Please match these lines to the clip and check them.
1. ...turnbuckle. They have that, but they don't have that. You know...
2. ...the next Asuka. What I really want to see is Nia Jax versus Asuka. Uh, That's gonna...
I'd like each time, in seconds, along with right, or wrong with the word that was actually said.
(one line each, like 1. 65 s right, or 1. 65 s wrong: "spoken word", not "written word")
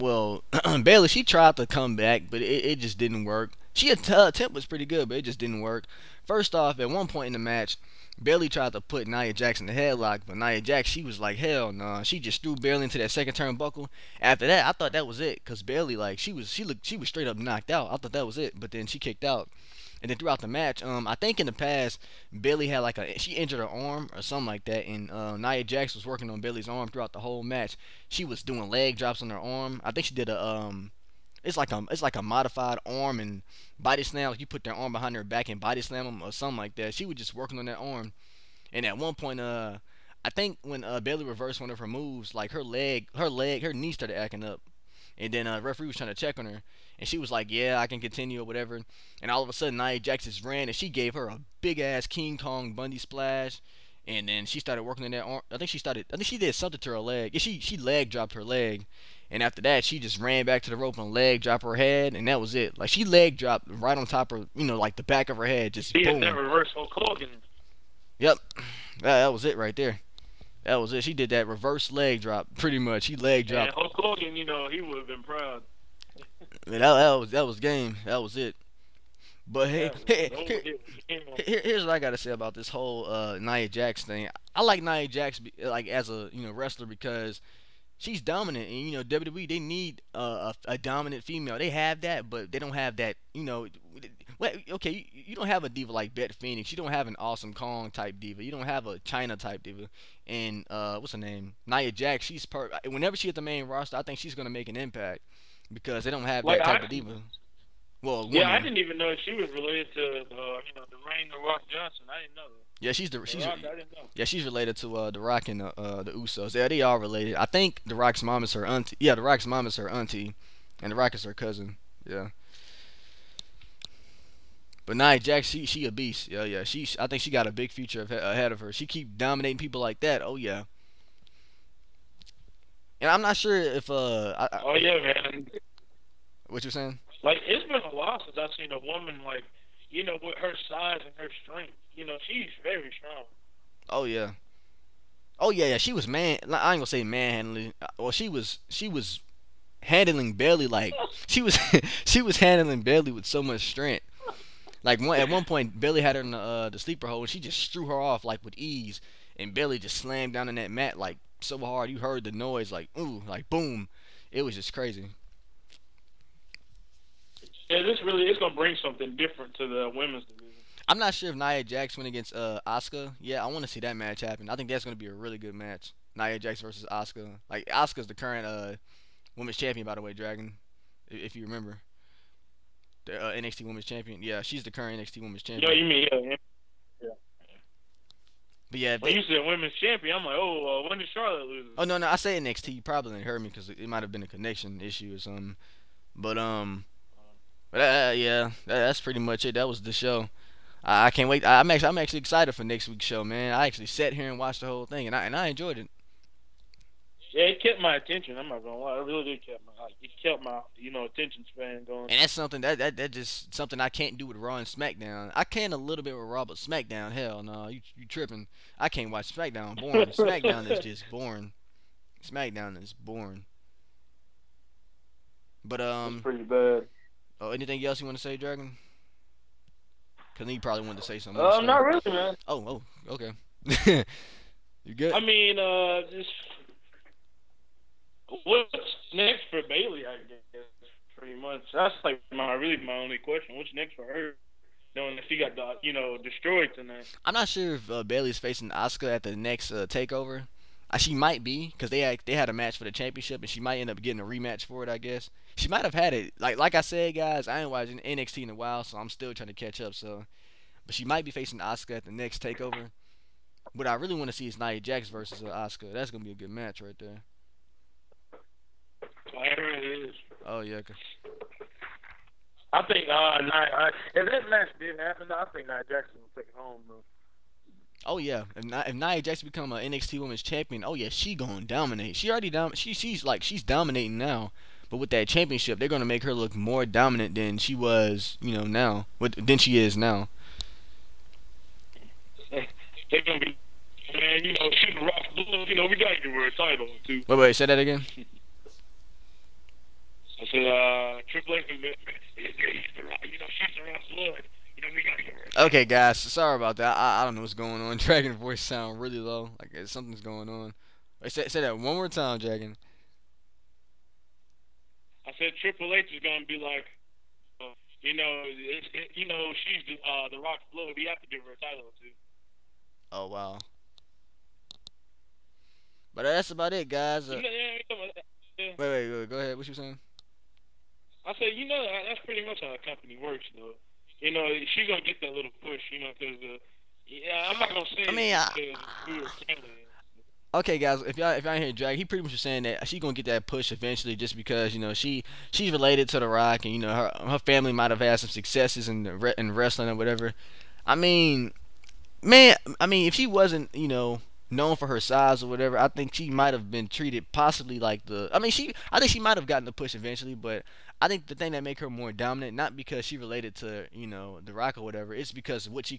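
1. 91 s wrong: "female", not "turnbuckle"
2. 262 s wrong: "Takeover", not "Asuka".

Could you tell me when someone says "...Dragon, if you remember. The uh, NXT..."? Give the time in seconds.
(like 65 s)
180 s.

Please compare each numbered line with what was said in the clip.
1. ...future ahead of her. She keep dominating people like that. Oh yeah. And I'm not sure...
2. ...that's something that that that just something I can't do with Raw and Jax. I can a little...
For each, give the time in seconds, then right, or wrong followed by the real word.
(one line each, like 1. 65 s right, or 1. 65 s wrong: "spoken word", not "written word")
1. 127 s right
2. 212 s wrong: "SmackDown", not "Jax".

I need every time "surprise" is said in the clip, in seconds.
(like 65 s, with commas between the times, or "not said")
not said.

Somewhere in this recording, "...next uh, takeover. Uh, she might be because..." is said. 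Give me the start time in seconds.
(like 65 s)
249 s.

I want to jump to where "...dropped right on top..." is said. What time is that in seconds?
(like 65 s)
63 s.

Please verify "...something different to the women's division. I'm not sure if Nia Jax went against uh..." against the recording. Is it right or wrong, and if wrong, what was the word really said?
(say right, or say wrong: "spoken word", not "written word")
right.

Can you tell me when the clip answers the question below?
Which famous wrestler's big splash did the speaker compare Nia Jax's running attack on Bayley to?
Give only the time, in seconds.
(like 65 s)
52 s.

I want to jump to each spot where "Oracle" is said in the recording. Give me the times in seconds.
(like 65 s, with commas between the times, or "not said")
not said.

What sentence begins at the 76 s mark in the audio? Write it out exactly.
Man, that, that was that was game.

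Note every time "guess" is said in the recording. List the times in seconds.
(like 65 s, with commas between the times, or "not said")
240 s, 254 s.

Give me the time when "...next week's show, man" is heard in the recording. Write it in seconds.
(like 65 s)
202 s.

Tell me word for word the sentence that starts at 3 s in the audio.
She attempt was pretty good, but it just didn't work.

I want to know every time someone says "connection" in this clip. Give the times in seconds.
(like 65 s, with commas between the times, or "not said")
194 s.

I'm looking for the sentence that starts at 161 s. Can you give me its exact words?
You heard the noise like ooh, like boom.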